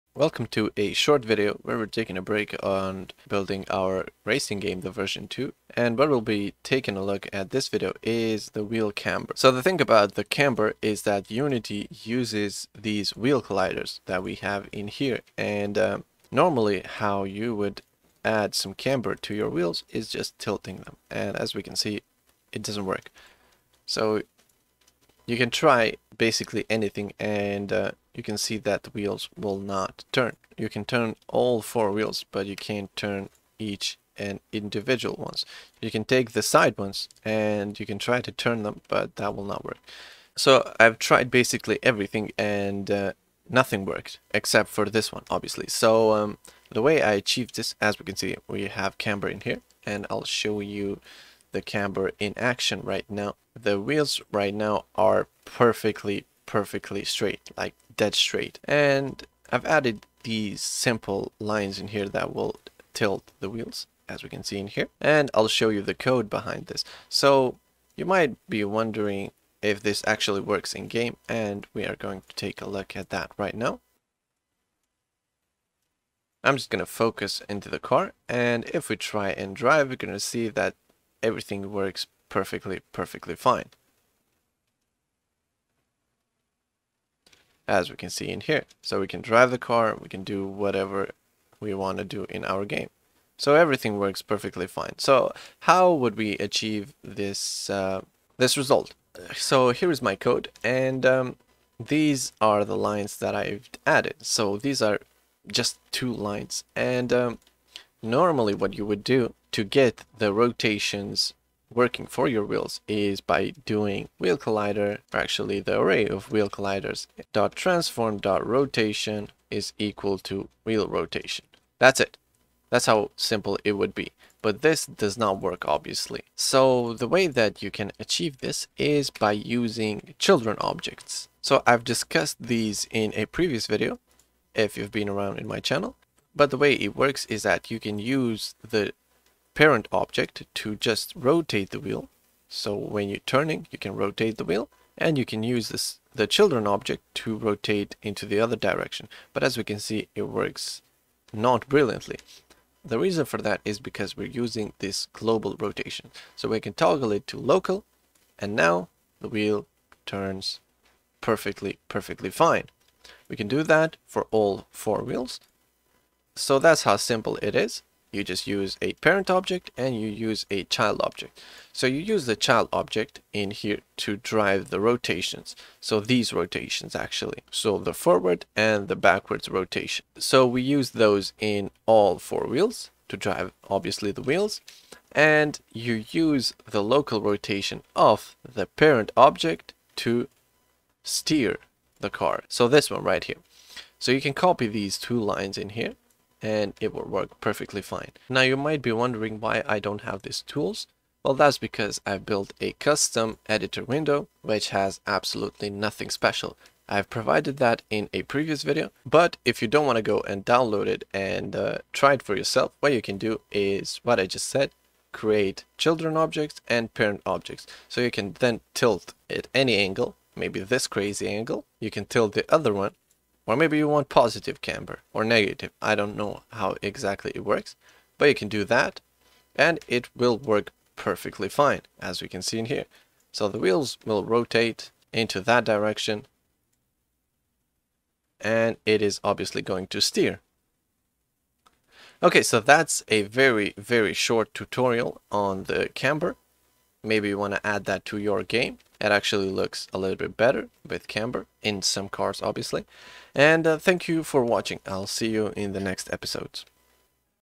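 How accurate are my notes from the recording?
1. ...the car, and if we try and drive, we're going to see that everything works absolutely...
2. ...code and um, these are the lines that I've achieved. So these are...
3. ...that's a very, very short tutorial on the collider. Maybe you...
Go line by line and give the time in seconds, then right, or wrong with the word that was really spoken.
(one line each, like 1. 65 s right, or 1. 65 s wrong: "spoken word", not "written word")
1. 77 s wrong: "perfectly", not "absolutely"
2. 100 s wrong: "added", not "achieved"
3. 242 s wrong: "camber", not "collider".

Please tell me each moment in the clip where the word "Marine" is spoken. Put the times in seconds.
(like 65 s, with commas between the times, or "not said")
not said.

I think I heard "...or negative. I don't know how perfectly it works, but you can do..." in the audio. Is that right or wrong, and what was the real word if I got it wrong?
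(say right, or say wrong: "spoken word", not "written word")
wrong: "exactly", not "perfectly".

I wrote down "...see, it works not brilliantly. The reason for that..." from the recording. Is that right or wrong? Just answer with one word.
right.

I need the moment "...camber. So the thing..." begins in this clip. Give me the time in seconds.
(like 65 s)
8 s.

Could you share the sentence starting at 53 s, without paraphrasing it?
The wheels right now are perfectly perfectly straight, like dead straight.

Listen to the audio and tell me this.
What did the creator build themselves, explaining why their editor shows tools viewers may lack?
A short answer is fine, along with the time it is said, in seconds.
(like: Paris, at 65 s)
custom editor window, at 202 s.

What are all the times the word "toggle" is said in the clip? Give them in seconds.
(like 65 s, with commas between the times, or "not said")
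156 s.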